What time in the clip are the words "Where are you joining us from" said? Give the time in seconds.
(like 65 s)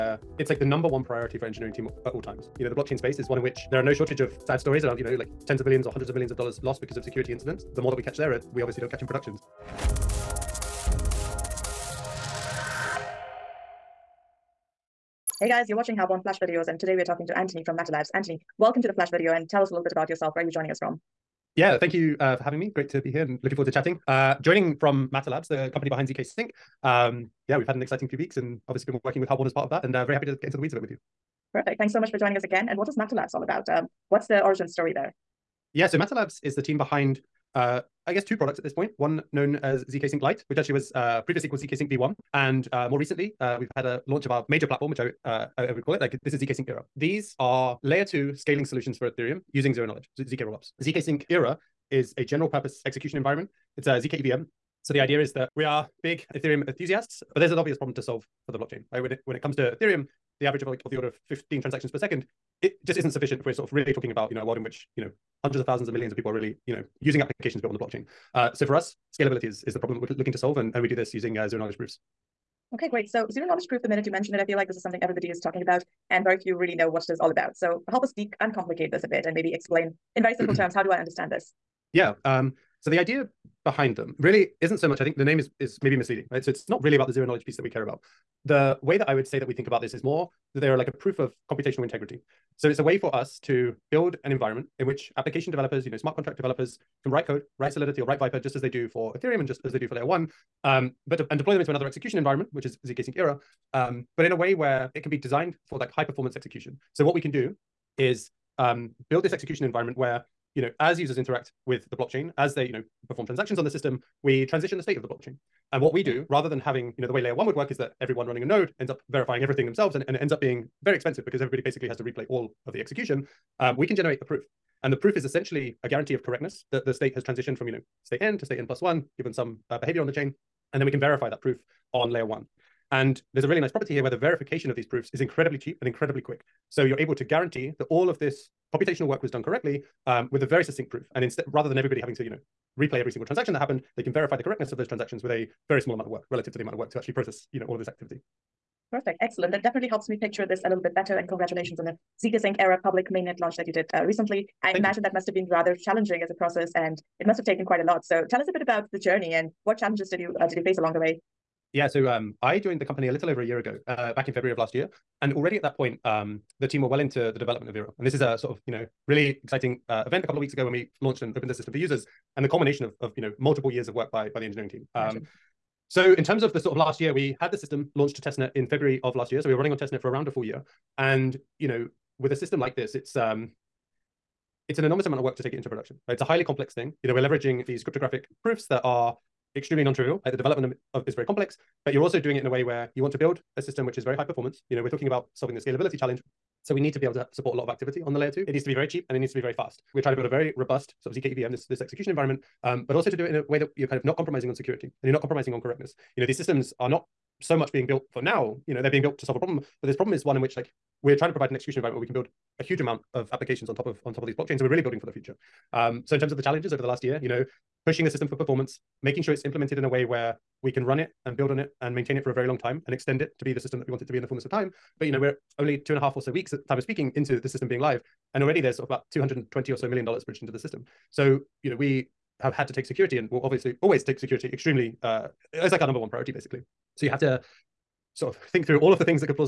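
20 s.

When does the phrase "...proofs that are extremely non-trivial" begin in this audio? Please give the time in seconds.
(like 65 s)
188 s.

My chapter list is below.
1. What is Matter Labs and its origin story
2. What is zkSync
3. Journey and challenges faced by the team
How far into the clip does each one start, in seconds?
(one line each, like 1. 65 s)
1. 32 s
2. 72 s
3. 158 s.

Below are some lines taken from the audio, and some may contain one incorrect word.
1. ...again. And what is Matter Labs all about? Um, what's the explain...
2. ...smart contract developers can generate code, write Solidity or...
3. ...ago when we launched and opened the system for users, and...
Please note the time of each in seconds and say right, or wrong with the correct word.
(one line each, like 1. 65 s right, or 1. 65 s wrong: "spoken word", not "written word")
1. 32 s wrong: "origin", not "explain"
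2. 95 s wrong: "write", not "generate"
3. 170 s right.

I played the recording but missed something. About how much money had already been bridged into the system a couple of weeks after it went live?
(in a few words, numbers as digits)
220 million dollars.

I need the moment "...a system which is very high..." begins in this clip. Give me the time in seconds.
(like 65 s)
193 s.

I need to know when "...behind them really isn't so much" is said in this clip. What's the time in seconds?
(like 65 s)
83 s.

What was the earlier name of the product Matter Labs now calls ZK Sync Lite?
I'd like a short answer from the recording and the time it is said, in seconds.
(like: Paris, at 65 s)
ZK Sync V1, at 41 s.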